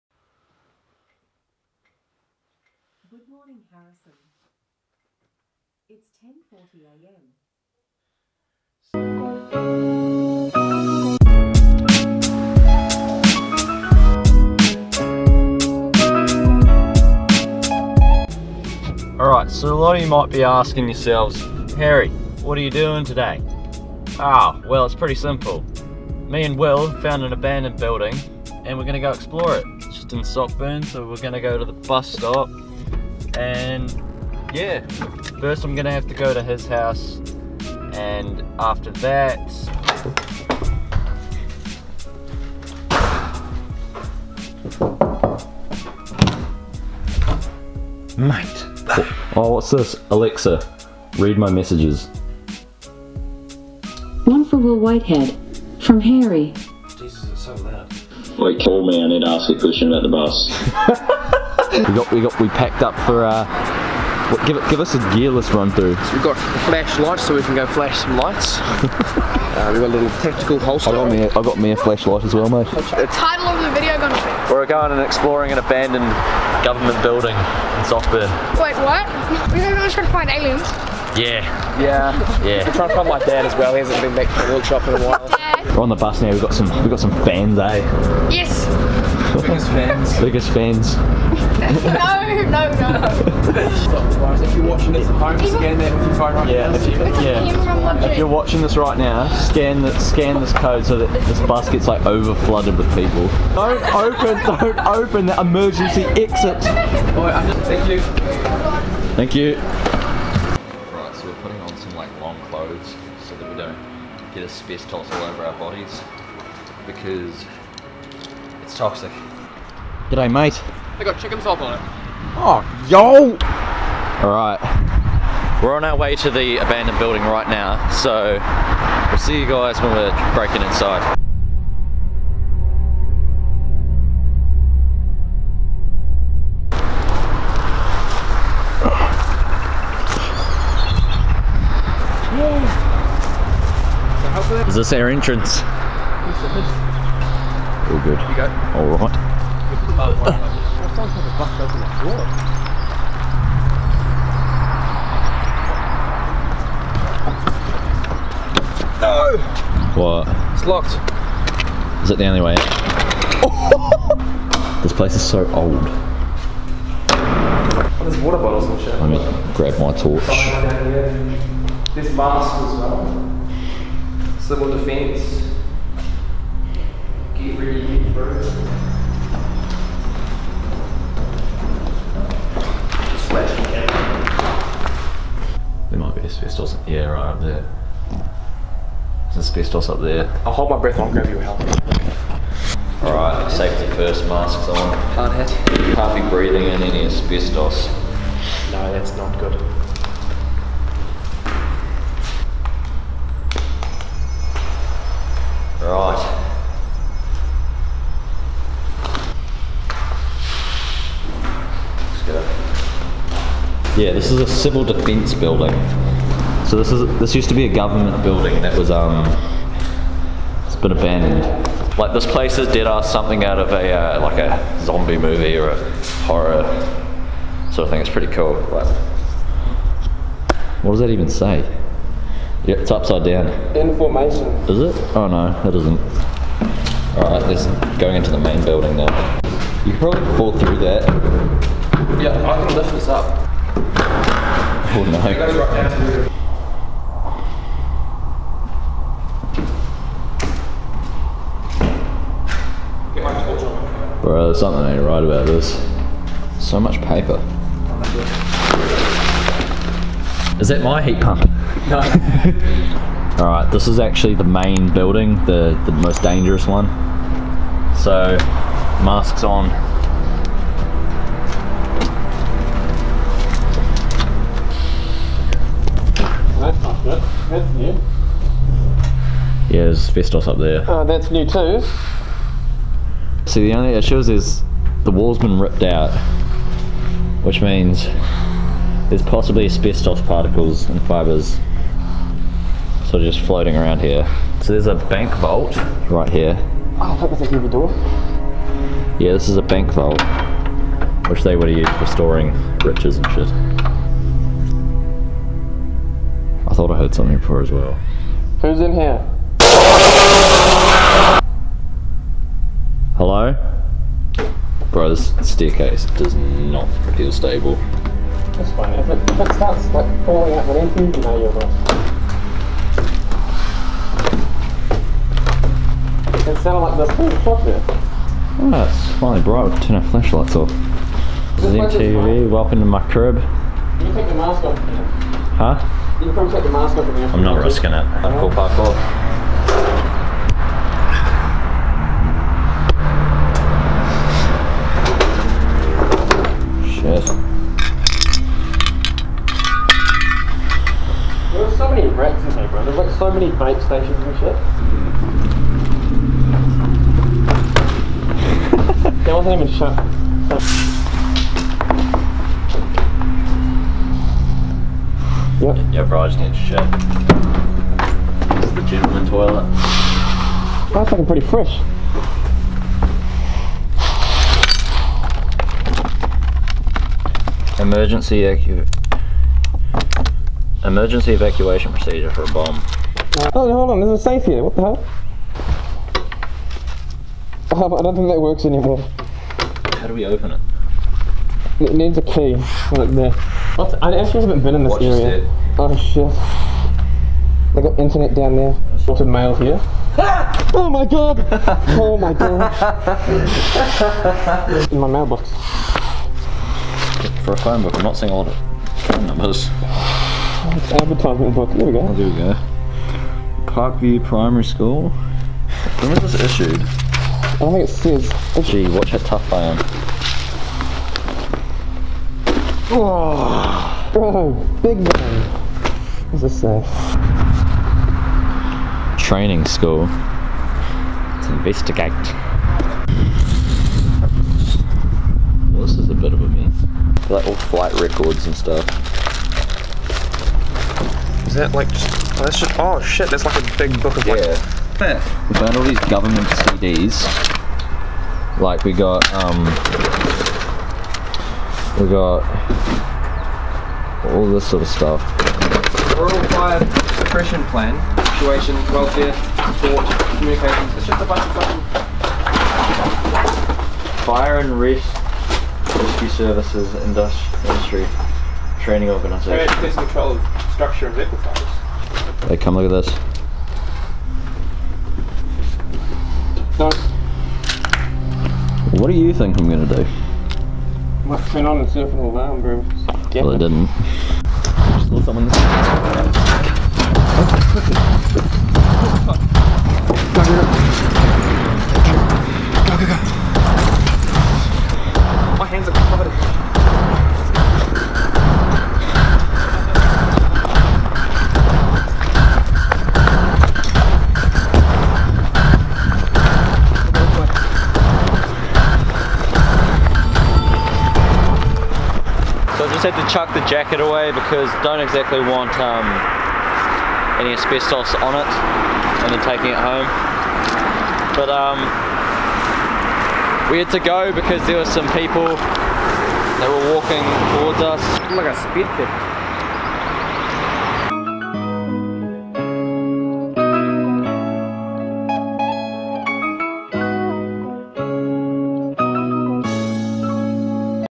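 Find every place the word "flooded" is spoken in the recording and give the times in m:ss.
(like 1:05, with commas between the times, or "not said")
1:42.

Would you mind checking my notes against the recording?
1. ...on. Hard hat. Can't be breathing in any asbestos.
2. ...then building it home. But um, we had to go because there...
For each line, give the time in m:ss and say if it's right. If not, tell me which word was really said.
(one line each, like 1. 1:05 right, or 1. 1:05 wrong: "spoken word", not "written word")
1. 3:14 right
2. 8:39 wrong: "taking", not "building".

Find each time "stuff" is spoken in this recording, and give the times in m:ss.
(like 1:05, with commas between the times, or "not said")
7:18, 7:34.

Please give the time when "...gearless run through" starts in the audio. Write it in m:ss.
1:05.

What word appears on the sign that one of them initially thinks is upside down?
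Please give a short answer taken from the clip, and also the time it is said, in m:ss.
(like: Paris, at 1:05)
Information, at 3:53.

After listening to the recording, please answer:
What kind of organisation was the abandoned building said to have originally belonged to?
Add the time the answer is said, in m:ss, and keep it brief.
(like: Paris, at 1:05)
Civil defence, at 3:34.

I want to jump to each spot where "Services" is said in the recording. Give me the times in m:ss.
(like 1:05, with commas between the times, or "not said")
7:46.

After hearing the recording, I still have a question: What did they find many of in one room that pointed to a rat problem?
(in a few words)
Bait stations.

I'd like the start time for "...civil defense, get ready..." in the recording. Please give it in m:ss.
2:54.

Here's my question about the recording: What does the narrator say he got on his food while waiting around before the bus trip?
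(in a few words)
Chicken salt.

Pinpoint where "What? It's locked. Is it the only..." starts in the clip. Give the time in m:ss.
2:40.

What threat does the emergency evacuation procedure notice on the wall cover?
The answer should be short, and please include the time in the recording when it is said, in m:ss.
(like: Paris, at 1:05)
A bomb, at 6:17.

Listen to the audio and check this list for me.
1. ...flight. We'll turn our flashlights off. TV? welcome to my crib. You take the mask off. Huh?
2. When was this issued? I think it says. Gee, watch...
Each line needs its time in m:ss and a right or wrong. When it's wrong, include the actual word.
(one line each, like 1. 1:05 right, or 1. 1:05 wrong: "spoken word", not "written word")
1. 5:29 wrong: "bright", not "flight"
2. 6:55 right.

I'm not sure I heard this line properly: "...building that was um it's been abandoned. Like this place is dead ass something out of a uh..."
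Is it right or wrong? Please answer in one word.
right.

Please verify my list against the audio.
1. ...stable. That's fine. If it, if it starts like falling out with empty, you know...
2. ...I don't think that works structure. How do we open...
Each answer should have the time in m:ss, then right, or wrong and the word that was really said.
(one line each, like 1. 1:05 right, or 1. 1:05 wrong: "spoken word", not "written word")
1. 5:17 right
2. 6:27 wrong: "anymore", not "structure".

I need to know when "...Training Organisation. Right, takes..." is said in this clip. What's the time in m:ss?
7:48.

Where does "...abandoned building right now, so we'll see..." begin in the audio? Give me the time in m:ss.
2:06.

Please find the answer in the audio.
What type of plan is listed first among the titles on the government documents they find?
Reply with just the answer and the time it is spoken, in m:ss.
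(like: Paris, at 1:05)
Rural fire suppression plan, at 7:36.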